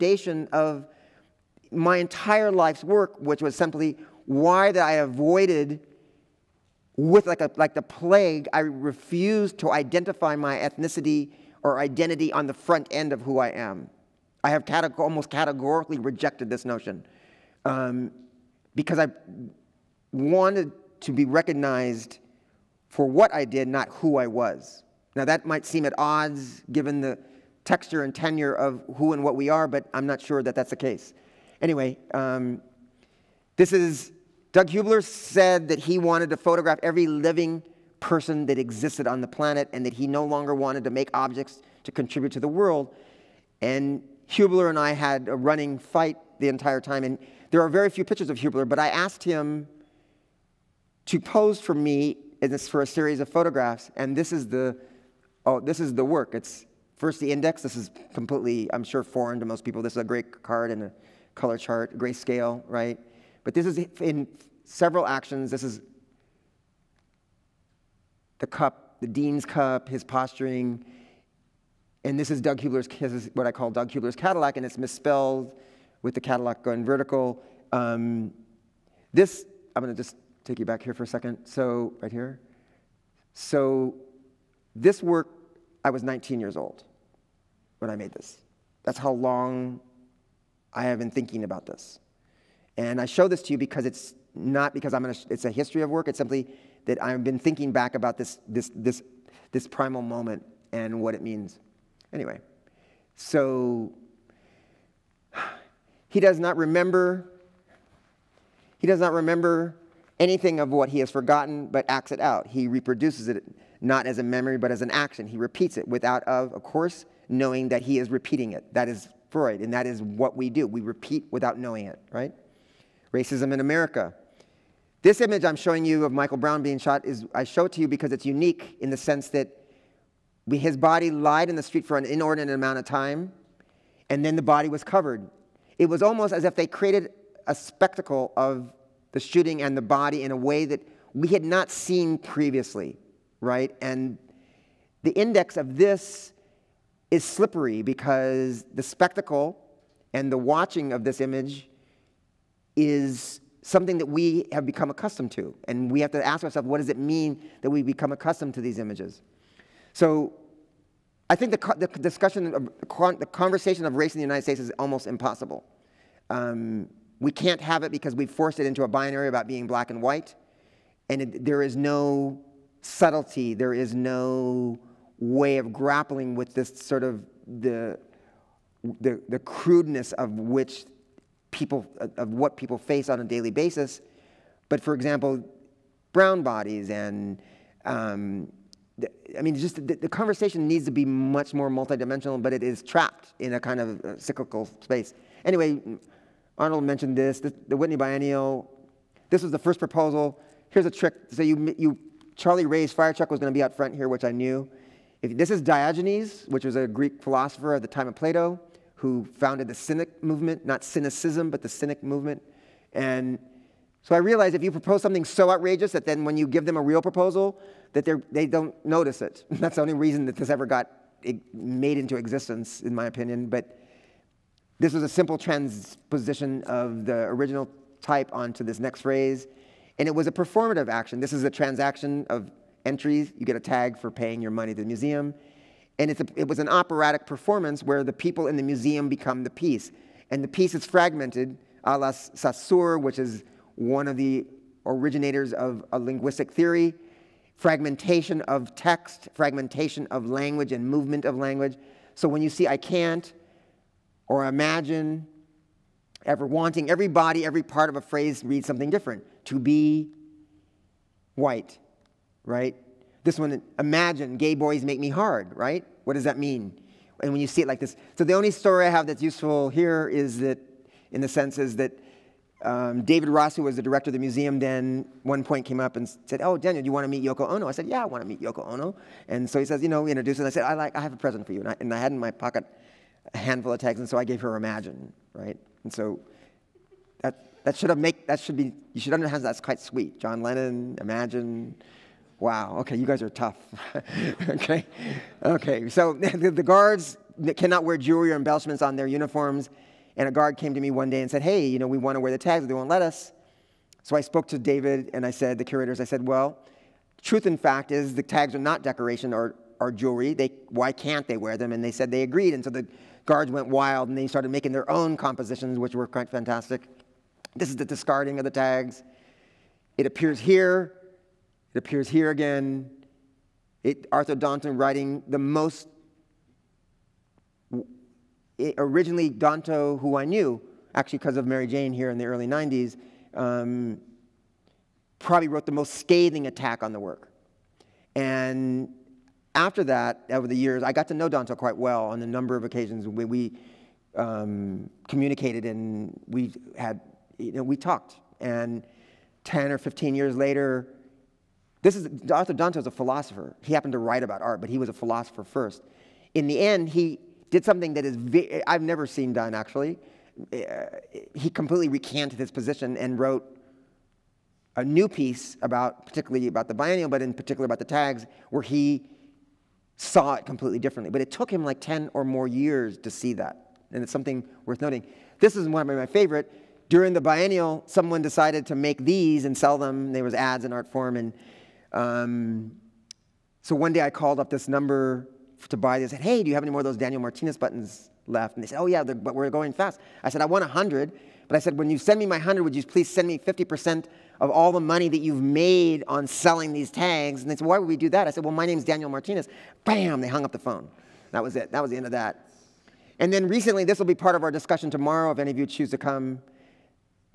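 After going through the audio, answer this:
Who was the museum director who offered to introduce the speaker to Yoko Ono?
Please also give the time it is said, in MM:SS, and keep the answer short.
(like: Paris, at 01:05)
David Ross, at 04:33.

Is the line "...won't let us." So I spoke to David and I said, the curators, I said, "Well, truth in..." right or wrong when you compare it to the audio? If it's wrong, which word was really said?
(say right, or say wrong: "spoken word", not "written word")
right.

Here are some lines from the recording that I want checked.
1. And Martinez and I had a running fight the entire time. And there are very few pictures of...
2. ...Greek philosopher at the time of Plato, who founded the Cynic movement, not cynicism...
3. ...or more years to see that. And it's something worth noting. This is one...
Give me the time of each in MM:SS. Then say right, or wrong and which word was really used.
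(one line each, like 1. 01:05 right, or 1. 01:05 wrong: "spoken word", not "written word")
1. 00:43 wrong: "Huebler", not "Martinez"
2. 03:26 right
3. 06:12 right.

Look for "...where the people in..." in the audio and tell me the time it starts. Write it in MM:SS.
03:57.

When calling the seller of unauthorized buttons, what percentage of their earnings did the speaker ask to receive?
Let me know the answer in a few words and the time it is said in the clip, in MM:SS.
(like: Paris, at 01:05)
50%, at 06:33.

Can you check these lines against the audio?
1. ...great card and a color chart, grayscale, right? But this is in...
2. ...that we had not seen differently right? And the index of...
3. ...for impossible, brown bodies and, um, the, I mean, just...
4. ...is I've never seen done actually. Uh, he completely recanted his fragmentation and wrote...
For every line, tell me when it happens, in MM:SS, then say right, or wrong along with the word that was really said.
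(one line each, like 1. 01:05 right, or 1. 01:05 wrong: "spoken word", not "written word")
1. 01:00 right
2. 02:20 wrong: "previously", not "differently"
3. 03:04 wrong: "example", not "impossible"
4. 05:58 wrong: "position", not "fragmentation".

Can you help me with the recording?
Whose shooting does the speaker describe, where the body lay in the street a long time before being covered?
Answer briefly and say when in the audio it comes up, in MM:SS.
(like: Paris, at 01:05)
Michael Brown, at 02:06.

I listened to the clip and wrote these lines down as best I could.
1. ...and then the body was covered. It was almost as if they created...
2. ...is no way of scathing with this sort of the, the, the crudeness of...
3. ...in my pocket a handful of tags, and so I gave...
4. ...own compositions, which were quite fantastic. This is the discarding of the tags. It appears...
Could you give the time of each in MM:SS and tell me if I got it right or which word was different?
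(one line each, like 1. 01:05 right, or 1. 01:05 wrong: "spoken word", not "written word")
1. 02:14 right
2. 02:53 wrong: "grappling", not "scathing"
3. 04:42 right
4. 05:14 right.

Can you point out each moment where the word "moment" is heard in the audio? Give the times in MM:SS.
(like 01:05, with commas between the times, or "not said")
01:40.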